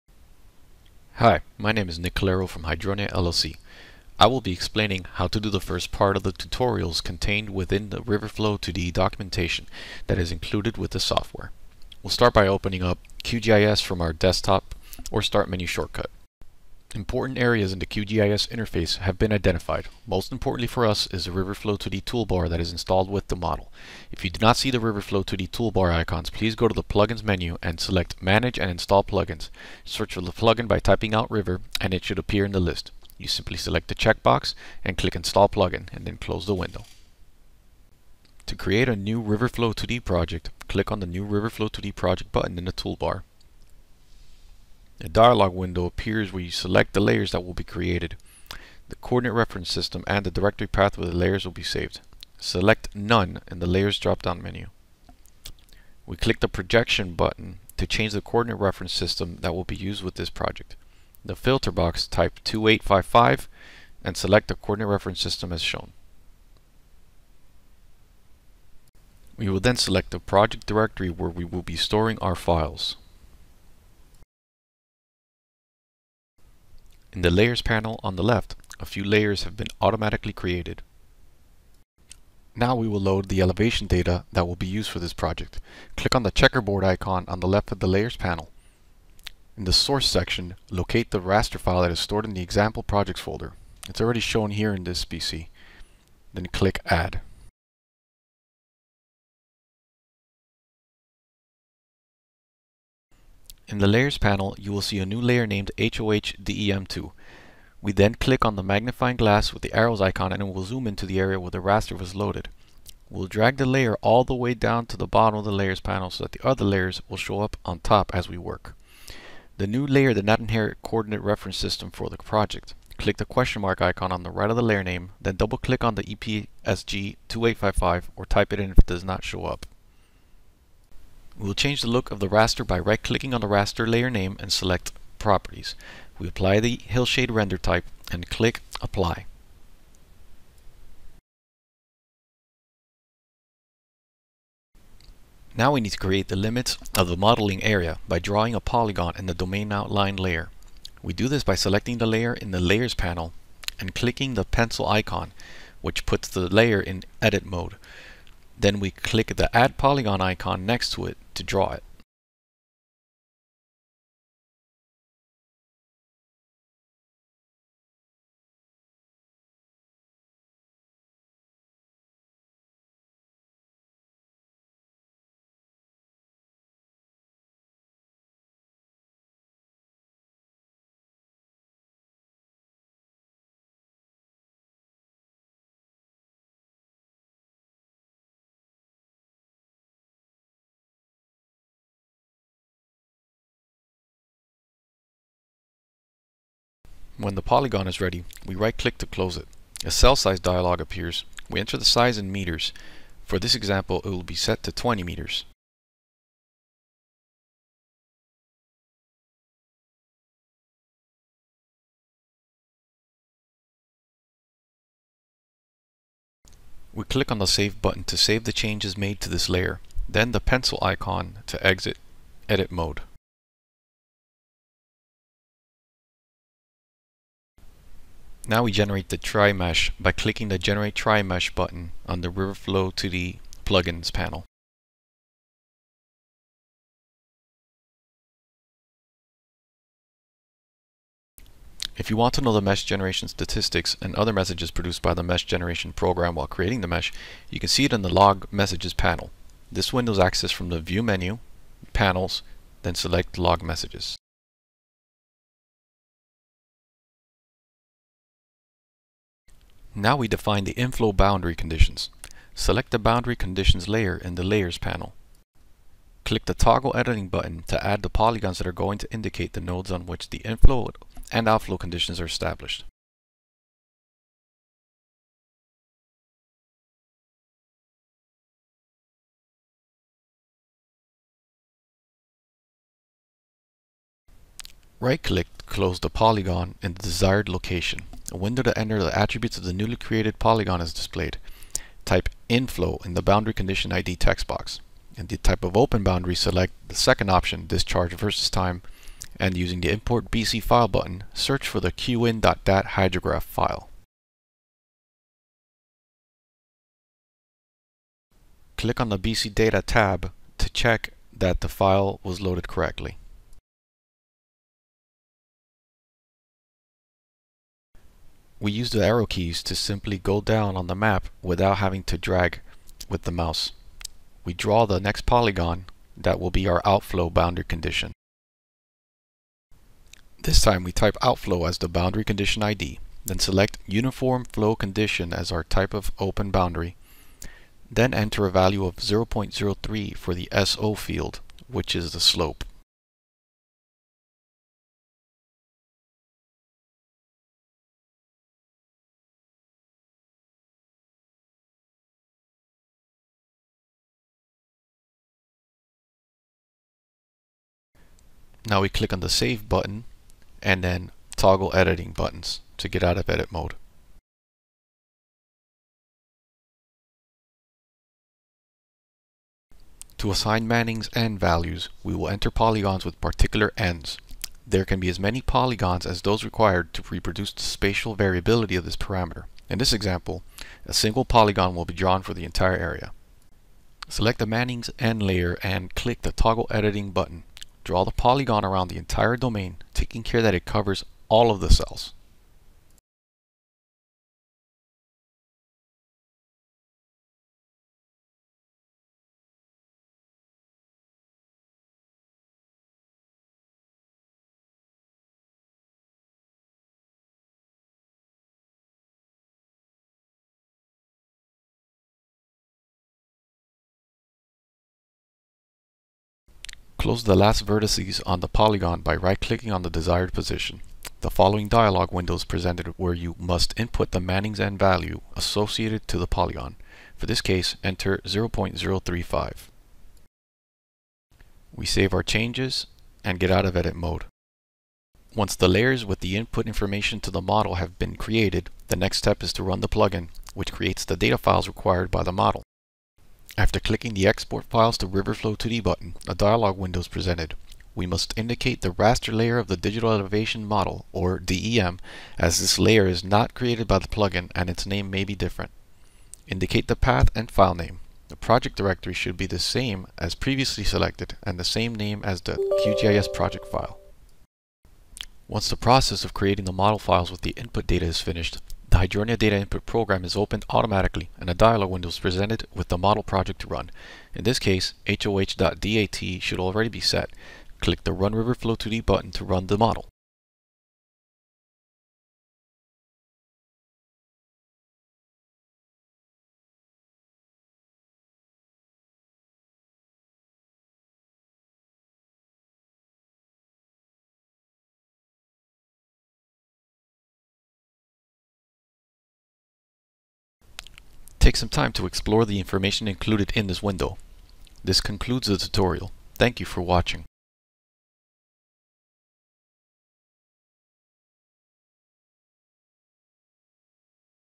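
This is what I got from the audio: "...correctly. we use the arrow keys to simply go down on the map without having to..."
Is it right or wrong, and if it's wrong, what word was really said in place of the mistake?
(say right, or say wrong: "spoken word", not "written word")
right.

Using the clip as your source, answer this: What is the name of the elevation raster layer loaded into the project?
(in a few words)
HOHDEM2.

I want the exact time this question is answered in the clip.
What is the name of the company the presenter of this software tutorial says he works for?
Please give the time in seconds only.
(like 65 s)
2 s.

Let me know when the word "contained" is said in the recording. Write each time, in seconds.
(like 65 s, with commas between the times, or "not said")
7 s.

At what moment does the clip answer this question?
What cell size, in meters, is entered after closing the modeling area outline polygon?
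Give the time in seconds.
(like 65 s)
204 s.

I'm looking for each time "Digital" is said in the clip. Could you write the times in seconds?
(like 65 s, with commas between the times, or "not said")
449 s.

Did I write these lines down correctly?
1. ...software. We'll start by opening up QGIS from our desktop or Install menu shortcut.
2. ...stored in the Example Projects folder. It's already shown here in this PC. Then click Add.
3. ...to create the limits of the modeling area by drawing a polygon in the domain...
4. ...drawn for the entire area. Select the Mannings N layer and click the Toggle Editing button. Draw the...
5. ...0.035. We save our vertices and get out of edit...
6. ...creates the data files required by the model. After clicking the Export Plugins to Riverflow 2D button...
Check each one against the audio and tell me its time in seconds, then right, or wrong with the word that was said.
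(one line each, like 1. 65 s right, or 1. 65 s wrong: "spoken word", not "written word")
1. 10 s wrong: "Start", not "Install"
2. 91 s right
3. 145 s right
4. 381 s right
5. 428 s wrong: "changes", not "vertices"
6. 440 s wrong: "Files", not "Plugins".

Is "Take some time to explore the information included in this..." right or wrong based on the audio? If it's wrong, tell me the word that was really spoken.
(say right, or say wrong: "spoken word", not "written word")
right.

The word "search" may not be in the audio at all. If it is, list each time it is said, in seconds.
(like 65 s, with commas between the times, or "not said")
29 s, 301 s.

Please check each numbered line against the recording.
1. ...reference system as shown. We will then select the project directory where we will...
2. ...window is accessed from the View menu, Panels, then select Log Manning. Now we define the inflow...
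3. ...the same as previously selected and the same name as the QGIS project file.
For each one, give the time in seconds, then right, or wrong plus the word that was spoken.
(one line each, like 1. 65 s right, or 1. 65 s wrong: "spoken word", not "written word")
1. 64 s right
2. 249 s wrong: "Messages", not "Manning"
3. 459 s right.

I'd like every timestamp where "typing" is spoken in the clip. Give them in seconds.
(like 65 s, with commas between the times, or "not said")
30 s.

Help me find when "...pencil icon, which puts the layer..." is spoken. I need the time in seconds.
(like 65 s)
154 s.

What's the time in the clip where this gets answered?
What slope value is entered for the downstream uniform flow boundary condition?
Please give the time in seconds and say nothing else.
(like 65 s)
338 s.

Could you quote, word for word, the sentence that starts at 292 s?
Type inflow in the boundary condition ID text box.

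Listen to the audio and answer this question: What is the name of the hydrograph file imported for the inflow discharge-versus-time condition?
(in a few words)
qin.dat.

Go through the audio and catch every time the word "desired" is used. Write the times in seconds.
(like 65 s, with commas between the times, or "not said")
287 s, 419 s.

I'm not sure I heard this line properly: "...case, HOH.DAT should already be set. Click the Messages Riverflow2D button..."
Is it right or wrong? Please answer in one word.
wrong.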